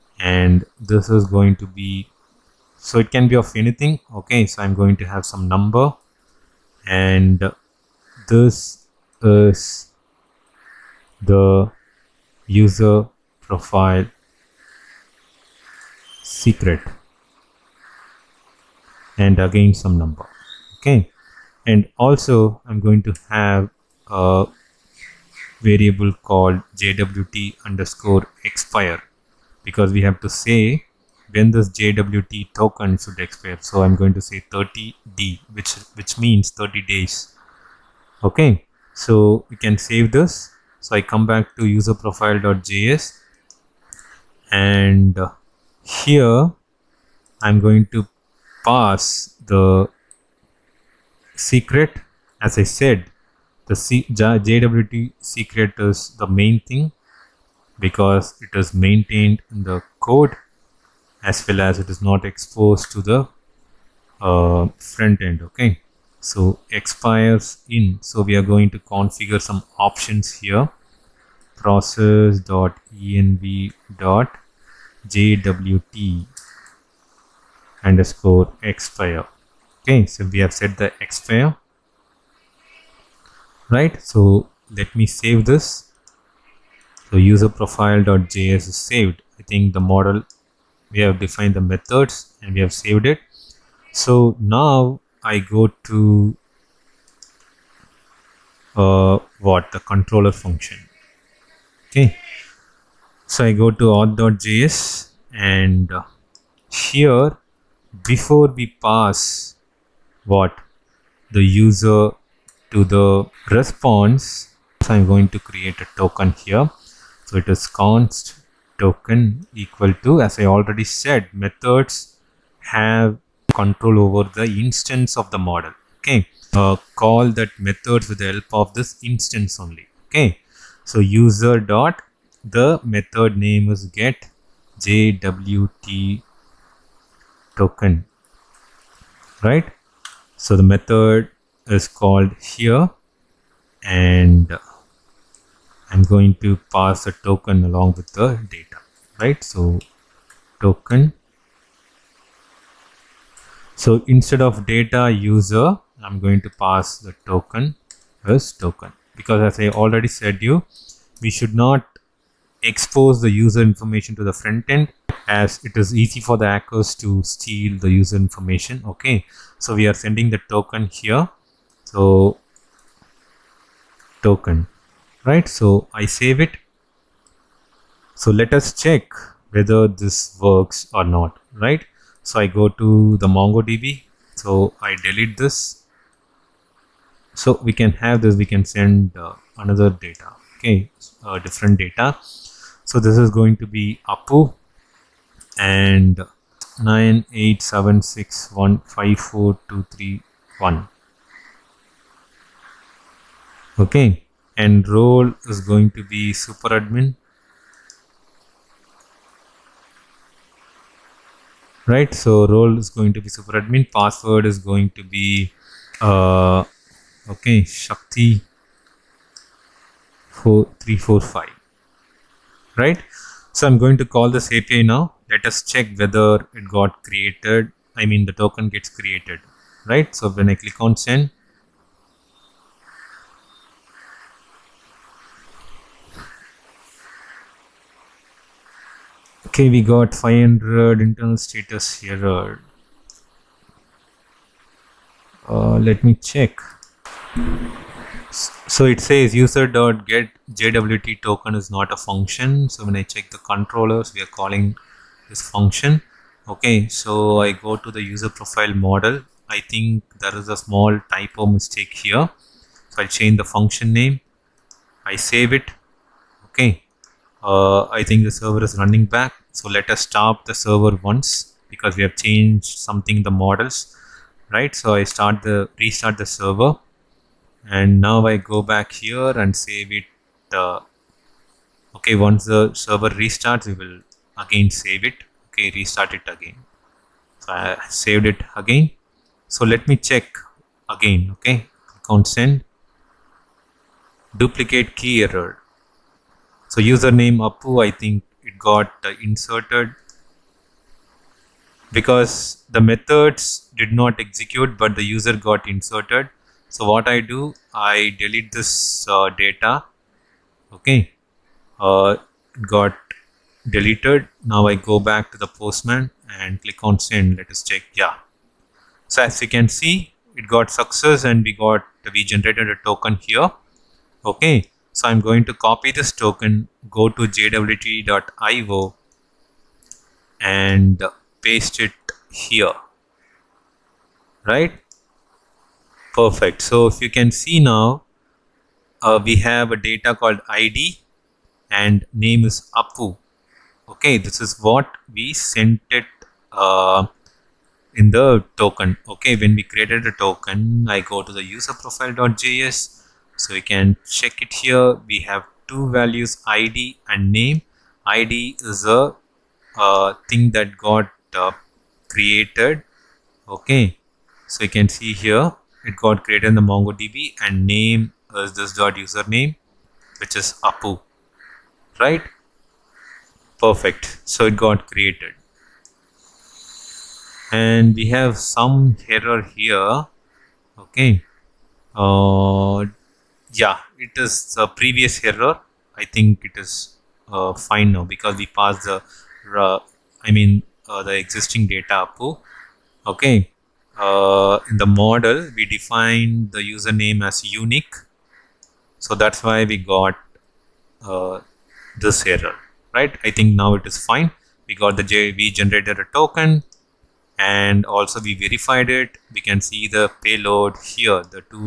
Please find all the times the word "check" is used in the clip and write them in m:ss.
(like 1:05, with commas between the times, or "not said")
2:58, 3:45, 4:06, 4:13, 4:49, 5:17, 5:54.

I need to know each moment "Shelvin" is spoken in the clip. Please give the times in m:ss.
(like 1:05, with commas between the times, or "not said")
not said.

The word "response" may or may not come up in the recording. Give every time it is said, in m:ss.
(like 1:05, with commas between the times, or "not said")
1:53.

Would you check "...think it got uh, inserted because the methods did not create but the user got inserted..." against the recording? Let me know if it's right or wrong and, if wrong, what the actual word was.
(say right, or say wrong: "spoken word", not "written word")
wrong: "execute", not "create".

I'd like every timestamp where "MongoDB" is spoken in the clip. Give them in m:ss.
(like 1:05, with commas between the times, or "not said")
3:03, 6:06.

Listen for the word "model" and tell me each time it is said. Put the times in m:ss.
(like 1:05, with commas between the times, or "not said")
1:29, 2:05, 4:18, 4:33, 6:34.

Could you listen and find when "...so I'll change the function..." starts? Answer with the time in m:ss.
4:22.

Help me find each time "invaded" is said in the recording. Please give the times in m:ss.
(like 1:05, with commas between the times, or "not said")
not said.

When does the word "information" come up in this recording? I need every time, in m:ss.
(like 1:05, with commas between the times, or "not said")
2:43, 2:48.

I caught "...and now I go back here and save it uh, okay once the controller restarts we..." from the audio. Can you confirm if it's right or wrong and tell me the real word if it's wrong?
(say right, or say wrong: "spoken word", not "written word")
wrong: "server", not "controller".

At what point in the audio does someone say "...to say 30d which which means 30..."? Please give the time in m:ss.
0:34.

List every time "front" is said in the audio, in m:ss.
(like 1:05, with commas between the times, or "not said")
1:04, 2:44.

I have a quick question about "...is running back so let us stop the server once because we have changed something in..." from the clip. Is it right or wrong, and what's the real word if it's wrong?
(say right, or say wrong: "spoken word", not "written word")
right.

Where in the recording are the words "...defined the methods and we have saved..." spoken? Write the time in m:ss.
1:31.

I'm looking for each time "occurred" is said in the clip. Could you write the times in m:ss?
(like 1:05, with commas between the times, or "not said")
not said.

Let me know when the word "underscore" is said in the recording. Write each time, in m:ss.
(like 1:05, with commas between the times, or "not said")
0:27, 1:17.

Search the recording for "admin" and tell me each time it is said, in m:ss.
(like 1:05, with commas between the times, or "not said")
3:26, 3:33.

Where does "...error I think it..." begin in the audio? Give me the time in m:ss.
6:25.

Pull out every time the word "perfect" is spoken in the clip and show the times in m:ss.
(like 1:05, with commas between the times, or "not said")
5:36, 6:13.